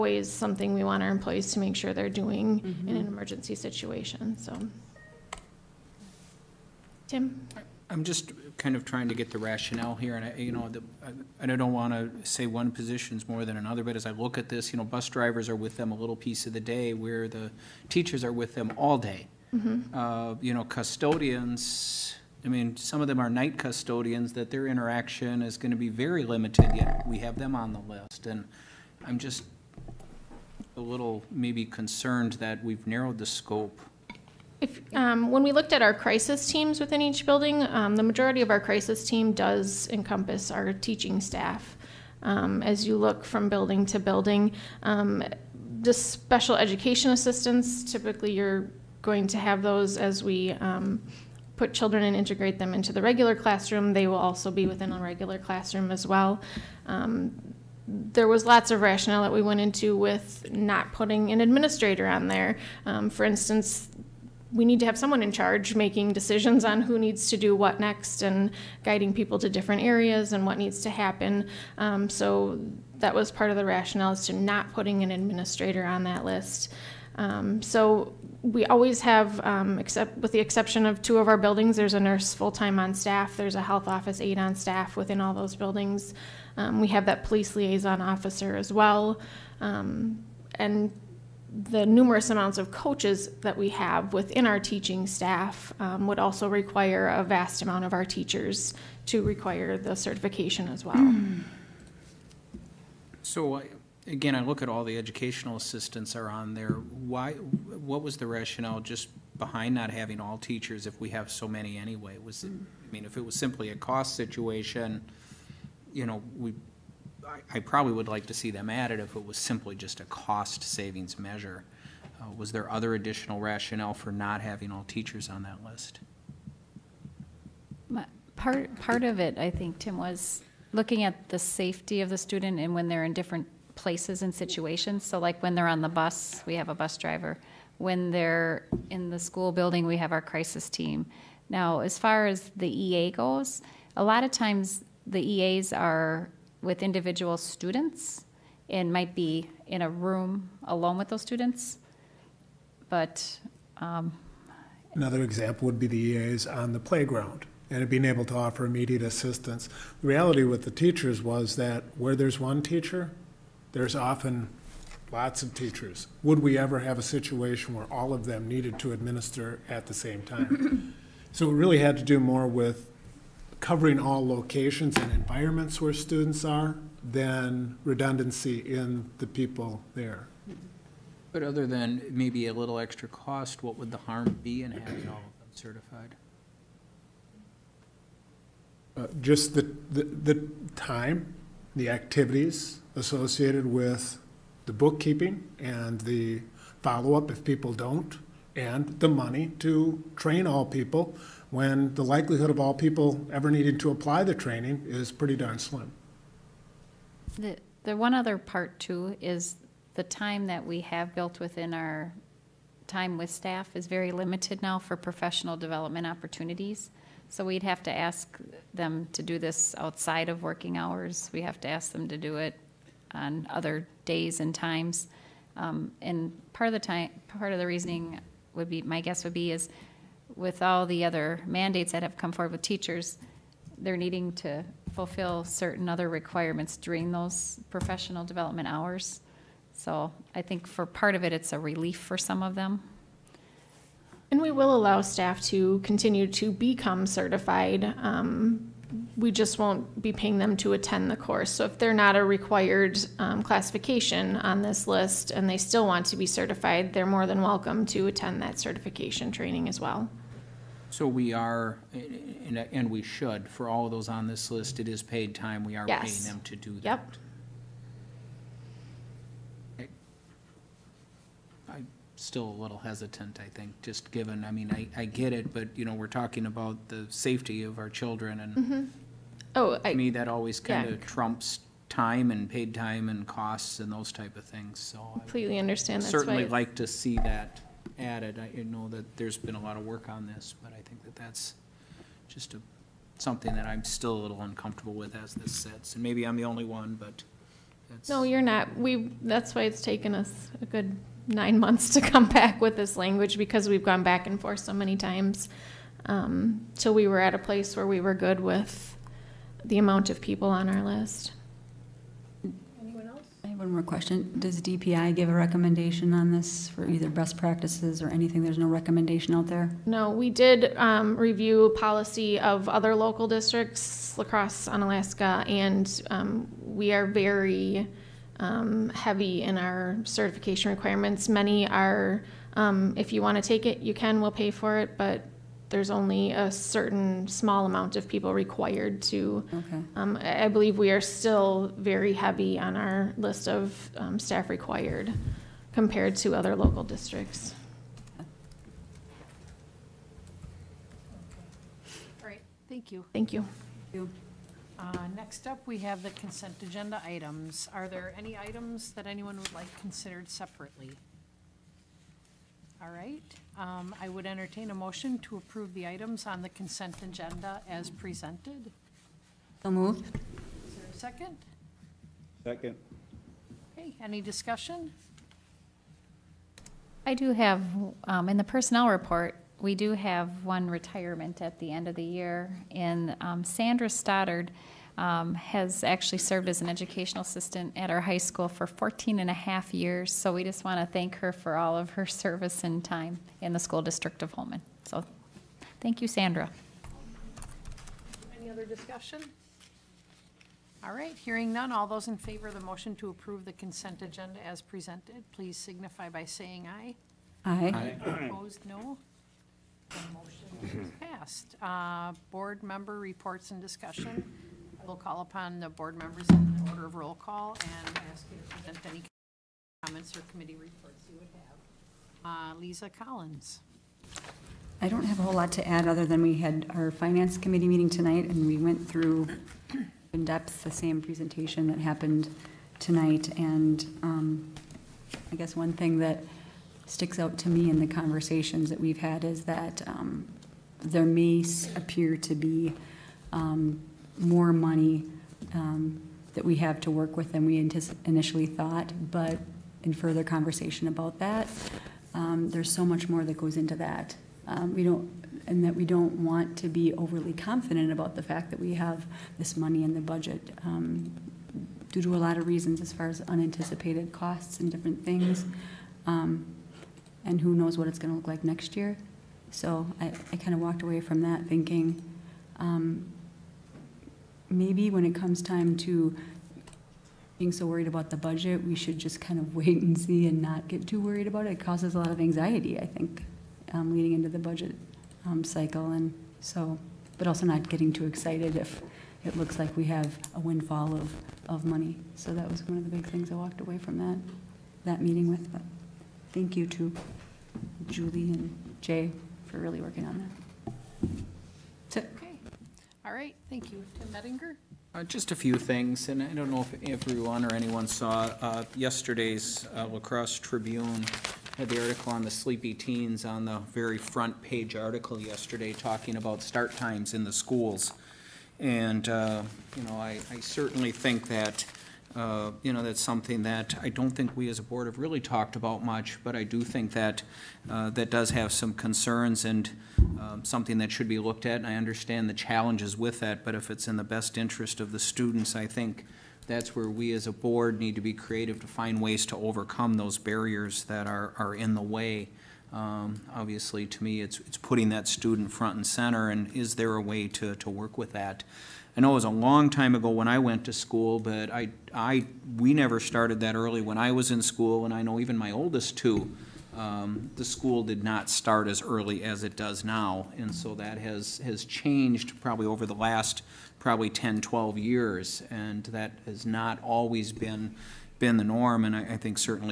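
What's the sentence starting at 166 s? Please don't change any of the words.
Would we ever have a situation where all of them needed to administer at the same time?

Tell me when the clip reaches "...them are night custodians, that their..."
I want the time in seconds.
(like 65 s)
23 s.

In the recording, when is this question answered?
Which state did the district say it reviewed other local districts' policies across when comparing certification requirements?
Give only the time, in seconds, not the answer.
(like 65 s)
324 s.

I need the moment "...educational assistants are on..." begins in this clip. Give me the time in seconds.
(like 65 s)
104 s.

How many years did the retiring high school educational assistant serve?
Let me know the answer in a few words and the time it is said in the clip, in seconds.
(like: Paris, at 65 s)
14 and a half years, at 388 s.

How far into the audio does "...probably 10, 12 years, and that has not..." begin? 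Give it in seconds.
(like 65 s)
563 s.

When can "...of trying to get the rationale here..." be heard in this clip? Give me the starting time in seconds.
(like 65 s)
8 s.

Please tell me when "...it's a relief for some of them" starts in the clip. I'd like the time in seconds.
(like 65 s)
241 s.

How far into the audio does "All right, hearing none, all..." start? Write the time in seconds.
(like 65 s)
400 s.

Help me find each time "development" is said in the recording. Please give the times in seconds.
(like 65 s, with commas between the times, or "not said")
215 s, 238 s.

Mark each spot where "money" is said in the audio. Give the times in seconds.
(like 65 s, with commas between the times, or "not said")
199 s, 444 s, 459 s, 491 s.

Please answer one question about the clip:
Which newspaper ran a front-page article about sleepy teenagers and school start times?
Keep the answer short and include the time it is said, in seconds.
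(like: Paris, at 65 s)
La Crosse Tribune, at 509 s.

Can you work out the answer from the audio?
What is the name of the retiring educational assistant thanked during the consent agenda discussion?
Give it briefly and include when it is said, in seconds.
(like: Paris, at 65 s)
Sandra Stoddard, at 383 s.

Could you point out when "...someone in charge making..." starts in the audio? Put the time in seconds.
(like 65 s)
64 s.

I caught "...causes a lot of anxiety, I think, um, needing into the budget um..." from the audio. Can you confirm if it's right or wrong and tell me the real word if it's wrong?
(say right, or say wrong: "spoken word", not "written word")
wrong: "leading", not "needing".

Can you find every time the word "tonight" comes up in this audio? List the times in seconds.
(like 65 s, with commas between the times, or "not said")
427 s, 432 s.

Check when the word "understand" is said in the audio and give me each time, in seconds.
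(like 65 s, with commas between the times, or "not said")
285 s, 531 s.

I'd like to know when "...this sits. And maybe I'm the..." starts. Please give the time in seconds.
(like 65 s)
295 s.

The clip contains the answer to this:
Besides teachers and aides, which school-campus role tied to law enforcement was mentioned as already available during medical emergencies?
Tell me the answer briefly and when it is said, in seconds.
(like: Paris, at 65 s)
police liaison officer, at 87 s.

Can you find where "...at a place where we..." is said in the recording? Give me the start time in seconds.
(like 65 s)
307 s.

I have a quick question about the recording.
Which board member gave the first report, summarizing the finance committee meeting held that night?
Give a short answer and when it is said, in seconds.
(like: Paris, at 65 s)
Lisa Collins, at 422 s.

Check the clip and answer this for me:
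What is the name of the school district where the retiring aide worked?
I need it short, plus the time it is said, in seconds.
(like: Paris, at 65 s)
Holmen, at 394 s.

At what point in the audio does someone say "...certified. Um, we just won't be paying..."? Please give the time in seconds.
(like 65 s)
247 s.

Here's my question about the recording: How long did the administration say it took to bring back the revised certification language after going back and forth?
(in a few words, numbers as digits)
9 months.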